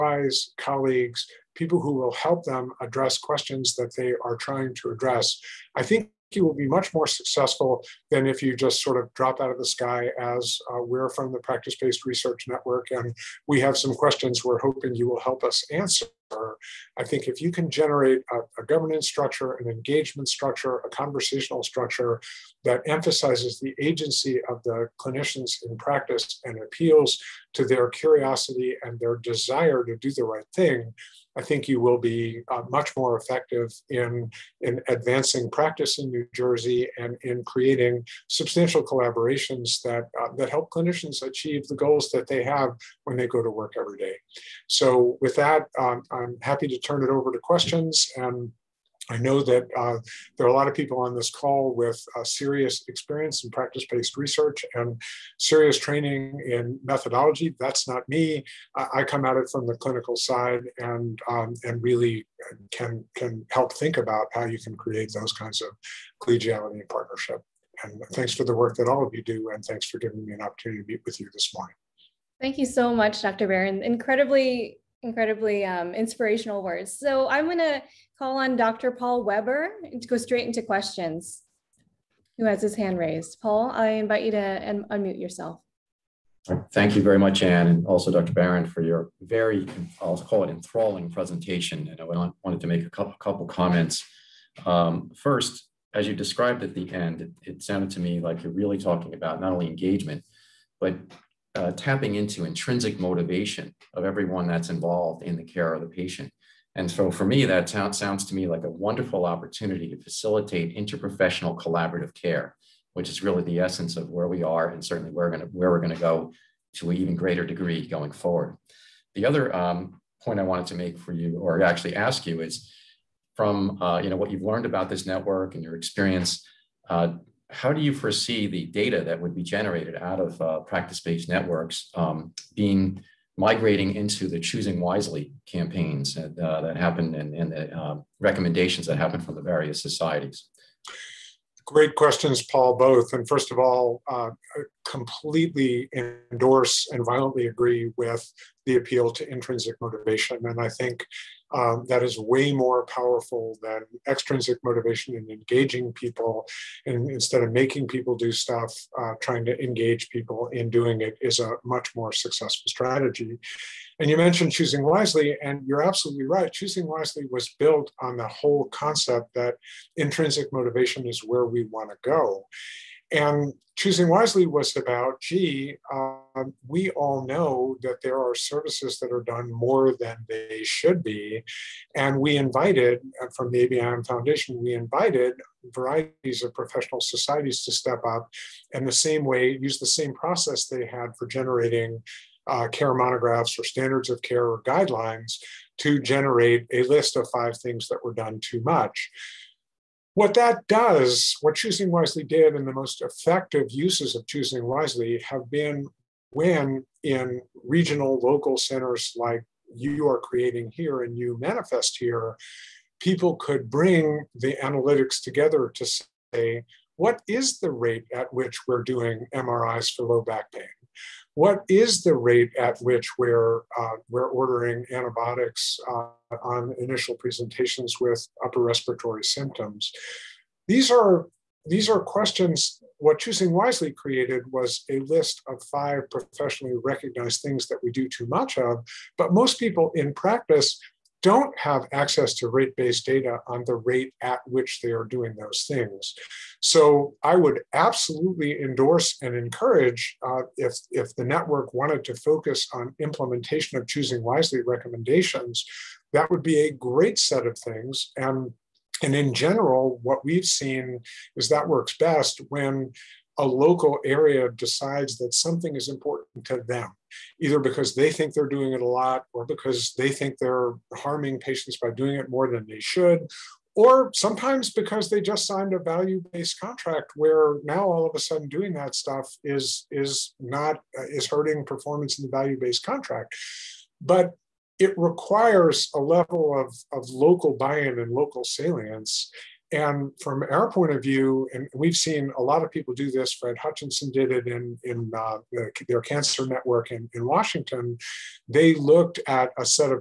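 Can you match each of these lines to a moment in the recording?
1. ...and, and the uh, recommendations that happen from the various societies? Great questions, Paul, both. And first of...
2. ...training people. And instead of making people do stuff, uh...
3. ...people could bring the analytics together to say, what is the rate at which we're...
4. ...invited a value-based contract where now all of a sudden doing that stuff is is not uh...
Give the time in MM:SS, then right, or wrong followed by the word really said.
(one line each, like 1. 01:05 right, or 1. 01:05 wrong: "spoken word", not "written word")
1. 02:17 right
2. 02:35 wrong: "engaging", not "training"
3. 03:32 right
4. 04:35 wrong: "signed", not "invited".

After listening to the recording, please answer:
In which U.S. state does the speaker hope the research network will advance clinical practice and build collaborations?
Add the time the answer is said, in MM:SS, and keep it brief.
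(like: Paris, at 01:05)
New Jersey, at 00:36.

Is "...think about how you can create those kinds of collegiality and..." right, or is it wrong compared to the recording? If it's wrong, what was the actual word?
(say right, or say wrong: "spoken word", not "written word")
right.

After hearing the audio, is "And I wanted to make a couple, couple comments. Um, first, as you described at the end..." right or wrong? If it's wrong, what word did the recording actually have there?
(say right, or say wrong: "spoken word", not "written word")
right.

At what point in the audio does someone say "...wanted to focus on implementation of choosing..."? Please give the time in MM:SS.
04:11.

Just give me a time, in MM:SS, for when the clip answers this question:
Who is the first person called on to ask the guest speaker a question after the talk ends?
01:18.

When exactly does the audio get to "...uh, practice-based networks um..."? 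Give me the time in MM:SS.
02:10.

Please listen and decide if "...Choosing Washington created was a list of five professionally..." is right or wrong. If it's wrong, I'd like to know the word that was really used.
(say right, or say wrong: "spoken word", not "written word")
wrong: "Wisely", not "Washington".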